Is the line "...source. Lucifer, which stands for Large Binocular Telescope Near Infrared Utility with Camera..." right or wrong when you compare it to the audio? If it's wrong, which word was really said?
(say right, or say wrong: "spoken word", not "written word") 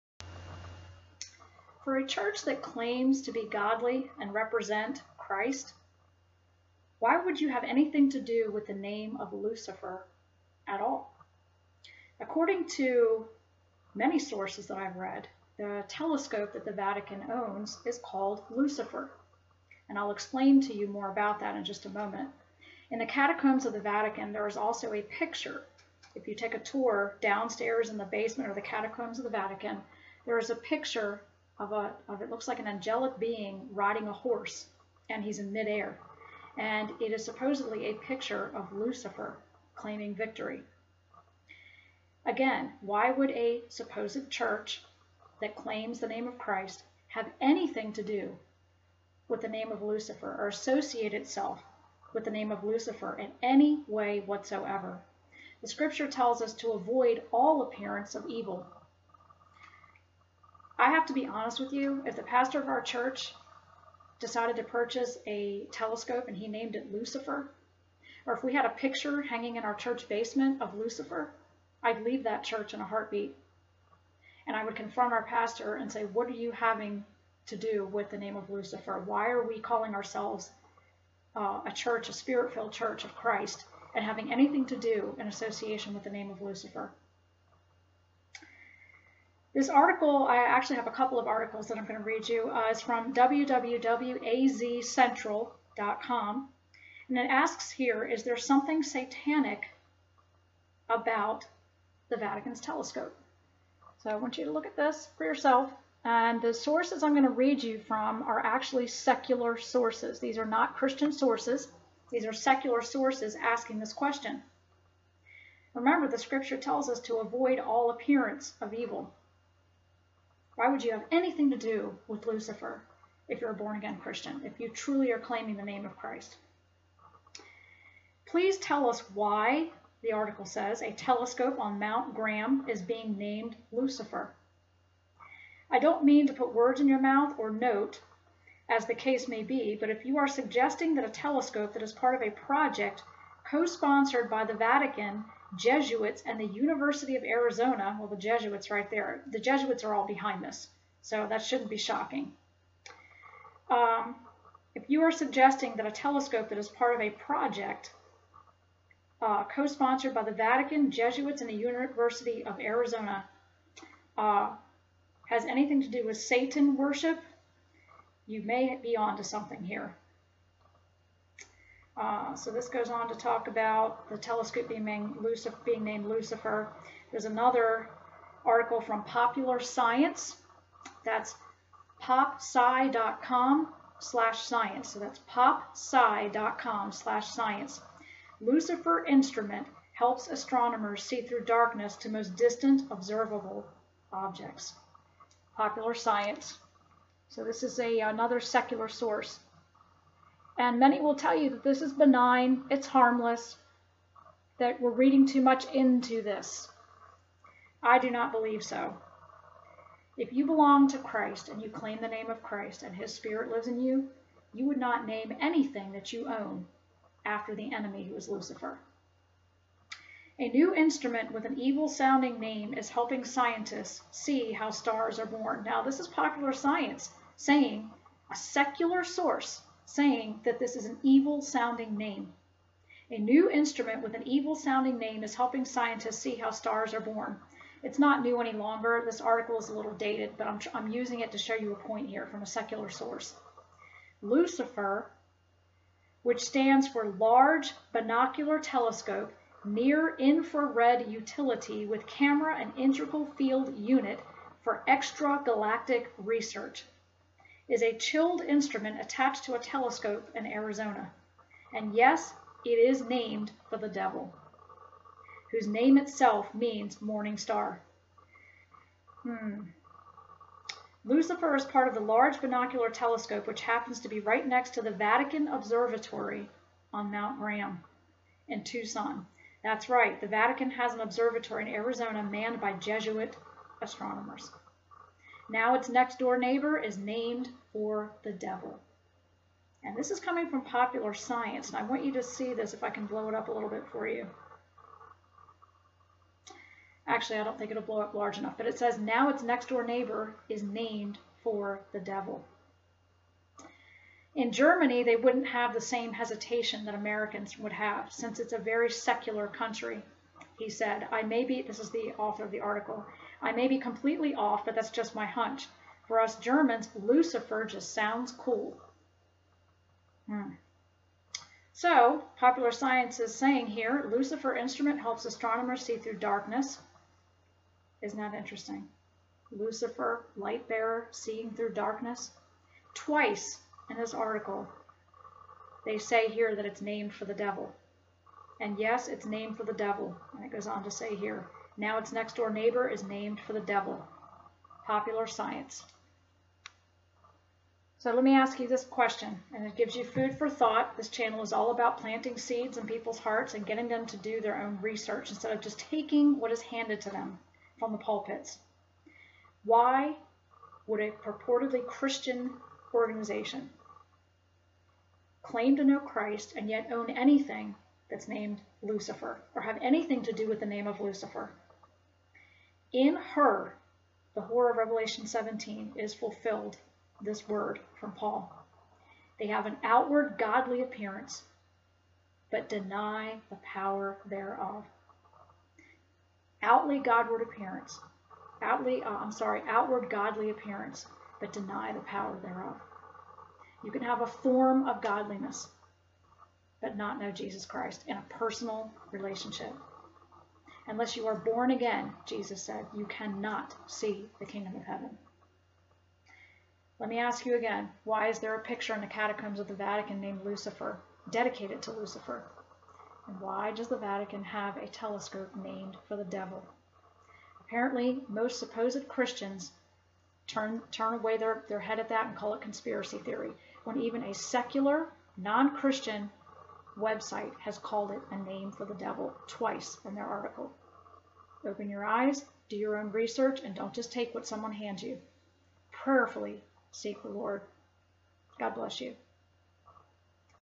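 right.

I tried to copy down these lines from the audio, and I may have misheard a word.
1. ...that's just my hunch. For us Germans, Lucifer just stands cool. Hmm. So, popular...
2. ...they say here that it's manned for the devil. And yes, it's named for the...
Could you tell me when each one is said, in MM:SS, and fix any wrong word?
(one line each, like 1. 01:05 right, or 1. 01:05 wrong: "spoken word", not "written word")
1. 05:14 wrong: "sounds", not "stands"
2. 05:35 wrong: "named", not "manned".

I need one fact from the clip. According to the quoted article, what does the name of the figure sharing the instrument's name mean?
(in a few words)
morning star.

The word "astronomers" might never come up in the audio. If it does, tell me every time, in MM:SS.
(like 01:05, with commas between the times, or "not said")
03:10, 04:43, 05:25.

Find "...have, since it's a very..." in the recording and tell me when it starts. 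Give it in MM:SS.
05:07.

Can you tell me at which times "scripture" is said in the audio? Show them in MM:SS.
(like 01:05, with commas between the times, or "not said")
00:55, 01:56.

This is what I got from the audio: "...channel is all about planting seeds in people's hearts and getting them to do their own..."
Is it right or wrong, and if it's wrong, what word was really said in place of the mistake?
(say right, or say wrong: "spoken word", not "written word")
right.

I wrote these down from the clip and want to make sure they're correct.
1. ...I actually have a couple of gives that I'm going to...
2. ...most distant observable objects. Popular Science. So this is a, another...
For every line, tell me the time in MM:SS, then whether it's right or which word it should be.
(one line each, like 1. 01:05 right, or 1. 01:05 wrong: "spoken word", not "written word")
1. 01:30 wrong: "articles", not "gives"
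2. 03:12 right.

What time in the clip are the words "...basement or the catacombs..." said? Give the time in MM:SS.
00:28.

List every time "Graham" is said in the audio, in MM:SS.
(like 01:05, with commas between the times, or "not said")
02:12, 04:37.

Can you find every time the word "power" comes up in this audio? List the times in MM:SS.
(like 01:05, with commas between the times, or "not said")
06:23, 06:32.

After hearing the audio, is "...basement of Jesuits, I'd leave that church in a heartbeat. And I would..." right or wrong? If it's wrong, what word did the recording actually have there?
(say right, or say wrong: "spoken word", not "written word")
wrong: "Lucifer", not "Jesuits".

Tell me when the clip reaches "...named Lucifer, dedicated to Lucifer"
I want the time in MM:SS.
06:50.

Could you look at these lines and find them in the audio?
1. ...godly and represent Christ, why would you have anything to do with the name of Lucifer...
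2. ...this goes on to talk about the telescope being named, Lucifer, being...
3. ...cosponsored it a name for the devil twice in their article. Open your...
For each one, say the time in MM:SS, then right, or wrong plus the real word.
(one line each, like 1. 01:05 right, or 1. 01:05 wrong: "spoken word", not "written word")
1. 00:03 right
2. 02:52 right
3. 07:07 wrong: "called", not "cosponsored".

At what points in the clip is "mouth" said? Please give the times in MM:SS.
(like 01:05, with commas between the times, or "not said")
02:16.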